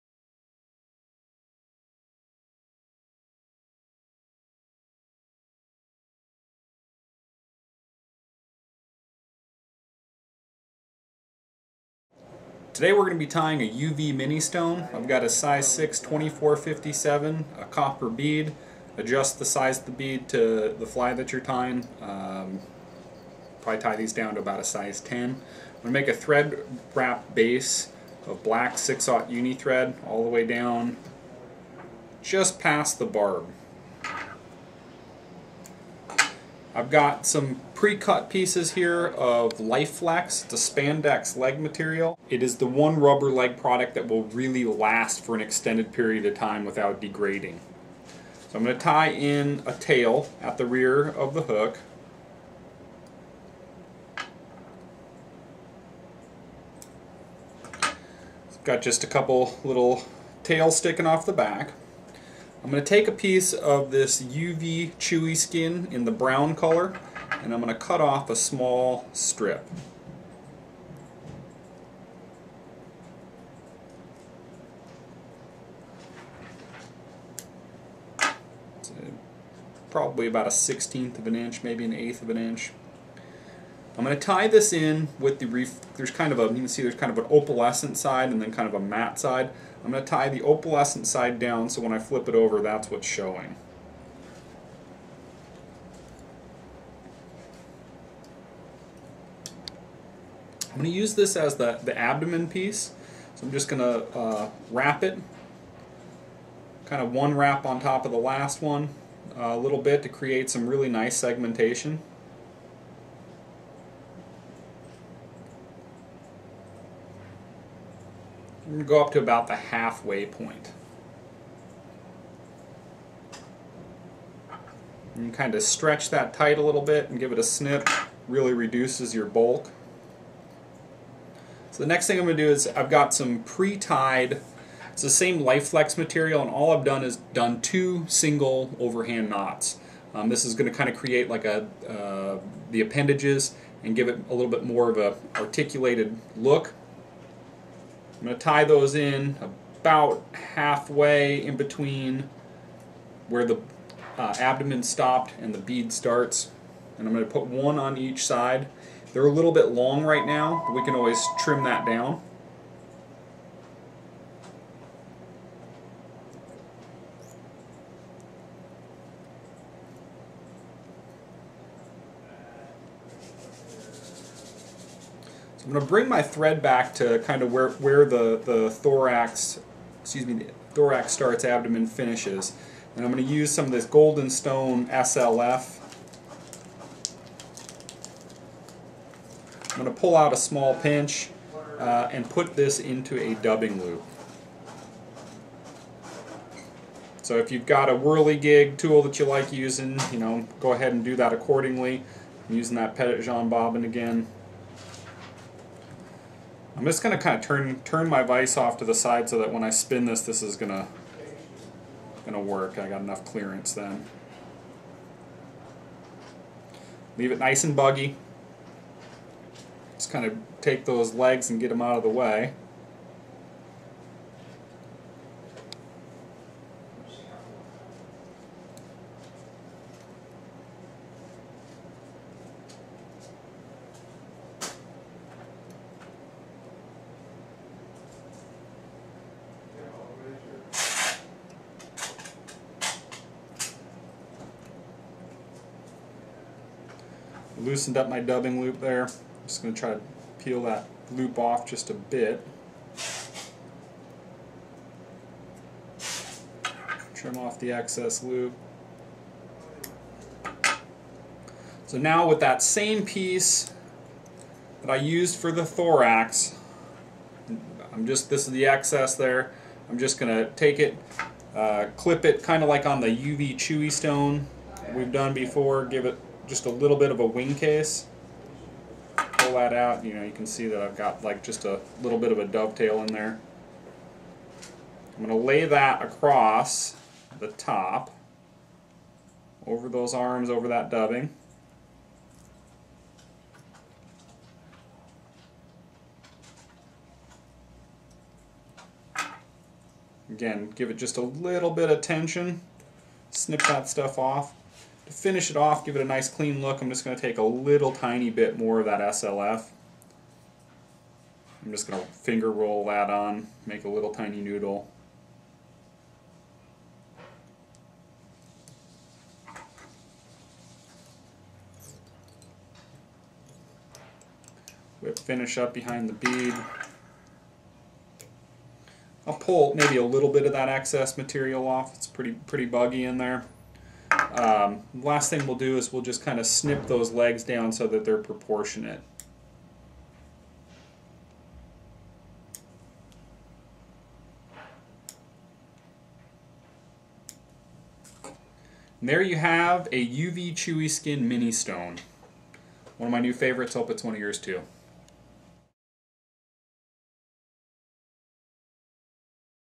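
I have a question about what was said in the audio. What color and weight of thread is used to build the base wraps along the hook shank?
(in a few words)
Black 6/0 Uni thread.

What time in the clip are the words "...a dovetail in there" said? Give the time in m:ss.
4:42.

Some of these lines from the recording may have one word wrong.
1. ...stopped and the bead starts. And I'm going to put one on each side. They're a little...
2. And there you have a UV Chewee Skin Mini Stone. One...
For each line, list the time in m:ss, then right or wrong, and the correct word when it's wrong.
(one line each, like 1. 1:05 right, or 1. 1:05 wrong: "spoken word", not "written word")
1. 2:34 right
2. 5:49 right.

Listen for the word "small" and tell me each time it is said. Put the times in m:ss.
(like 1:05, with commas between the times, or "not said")
1:08, 3:10.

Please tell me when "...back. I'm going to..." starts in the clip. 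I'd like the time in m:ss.
1:01.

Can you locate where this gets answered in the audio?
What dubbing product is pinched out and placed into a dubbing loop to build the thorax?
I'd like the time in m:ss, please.
3:03.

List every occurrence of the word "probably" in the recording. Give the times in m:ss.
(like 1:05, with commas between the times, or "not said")
0:23, 1:19.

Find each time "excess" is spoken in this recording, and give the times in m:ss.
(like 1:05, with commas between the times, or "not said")
4:17, 4:28, 5:30.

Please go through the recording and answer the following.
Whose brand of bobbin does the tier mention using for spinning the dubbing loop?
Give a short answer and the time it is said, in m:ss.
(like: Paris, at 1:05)
Petitjean, at 3:22.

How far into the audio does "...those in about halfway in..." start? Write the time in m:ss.
2:28.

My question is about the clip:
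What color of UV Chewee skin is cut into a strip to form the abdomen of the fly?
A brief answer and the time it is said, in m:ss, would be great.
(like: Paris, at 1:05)
Brown, at 1:06.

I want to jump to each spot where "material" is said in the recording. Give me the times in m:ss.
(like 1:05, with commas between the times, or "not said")
0:41, 2:15, 5:31.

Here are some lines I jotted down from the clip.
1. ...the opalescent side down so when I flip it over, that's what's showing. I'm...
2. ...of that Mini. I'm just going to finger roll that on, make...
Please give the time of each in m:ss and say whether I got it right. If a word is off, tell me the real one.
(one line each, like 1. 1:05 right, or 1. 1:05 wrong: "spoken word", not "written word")
1. 1:30 right
2. 5:08 wrong: "SLF", not "Mini".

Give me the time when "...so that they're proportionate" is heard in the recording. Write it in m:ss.
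5:37.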